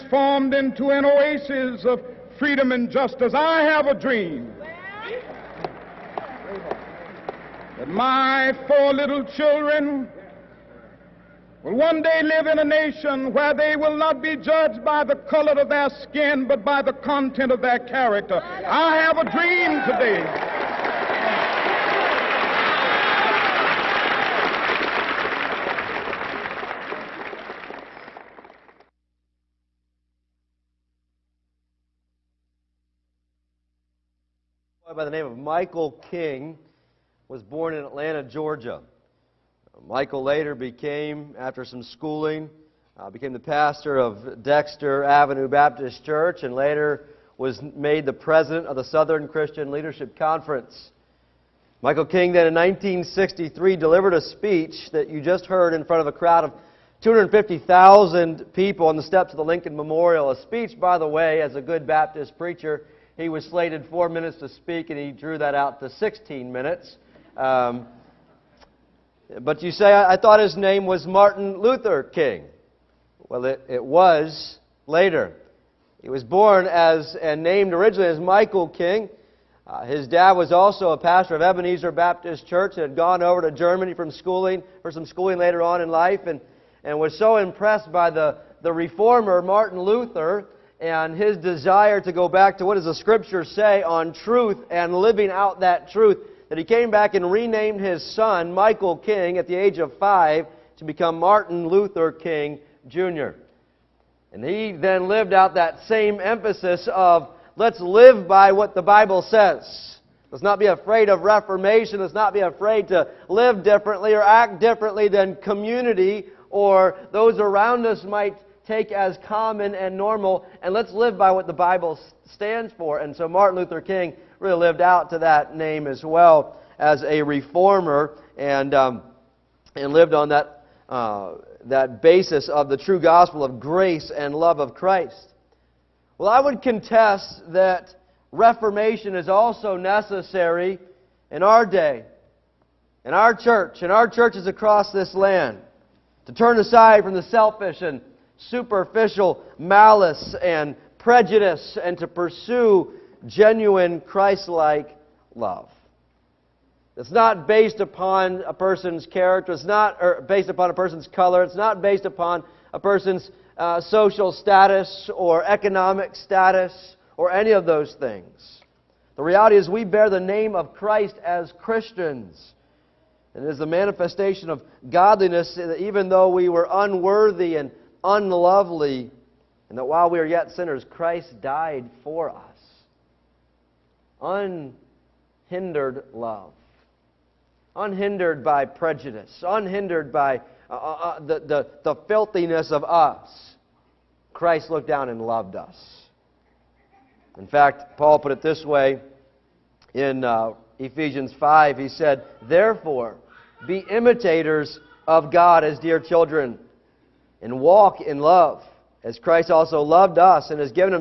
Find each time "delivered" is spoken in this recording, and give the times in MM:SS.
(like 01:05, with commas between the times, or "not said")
00:53.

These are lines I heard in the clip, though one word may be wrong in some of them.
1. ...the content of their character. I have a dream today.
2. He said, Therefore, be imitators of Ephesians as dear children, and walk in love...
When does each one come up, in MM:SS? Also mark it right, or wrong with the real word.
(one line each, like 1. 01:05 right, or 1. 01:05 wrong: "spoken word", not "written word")
1. 00:16 right
2. 03:21 wrong: "God", not "Ephesians".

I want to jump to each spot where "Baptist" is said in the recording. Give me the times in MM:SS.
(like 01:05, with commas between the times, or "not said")
00:45, 01:01, 01:21.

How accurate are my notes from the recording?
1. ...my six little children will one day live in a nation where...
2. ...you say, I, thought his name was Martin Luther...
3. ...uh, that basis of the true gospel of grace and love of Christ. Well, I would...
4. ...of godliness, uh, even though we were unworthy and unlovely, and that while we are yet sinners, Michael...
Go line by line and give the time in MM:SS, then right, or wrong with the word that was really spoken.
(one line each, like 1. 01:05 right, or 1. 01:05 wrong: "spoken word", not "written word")
1. 00:07 wrong: "four", not "six"
2. 01:09 right
3. 02:10 right
4. 02:54 wrong: "Christ", not "Michael".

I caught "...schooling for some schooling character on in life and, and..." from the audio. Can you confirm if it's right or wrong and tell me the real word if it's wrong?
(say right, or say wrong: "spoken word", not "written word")
wrong: "later", not "character".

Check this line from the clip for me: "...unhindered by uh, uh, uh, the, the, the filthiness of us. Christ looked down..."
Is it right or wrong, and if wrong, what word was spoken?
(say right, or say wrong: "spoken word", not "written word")
right.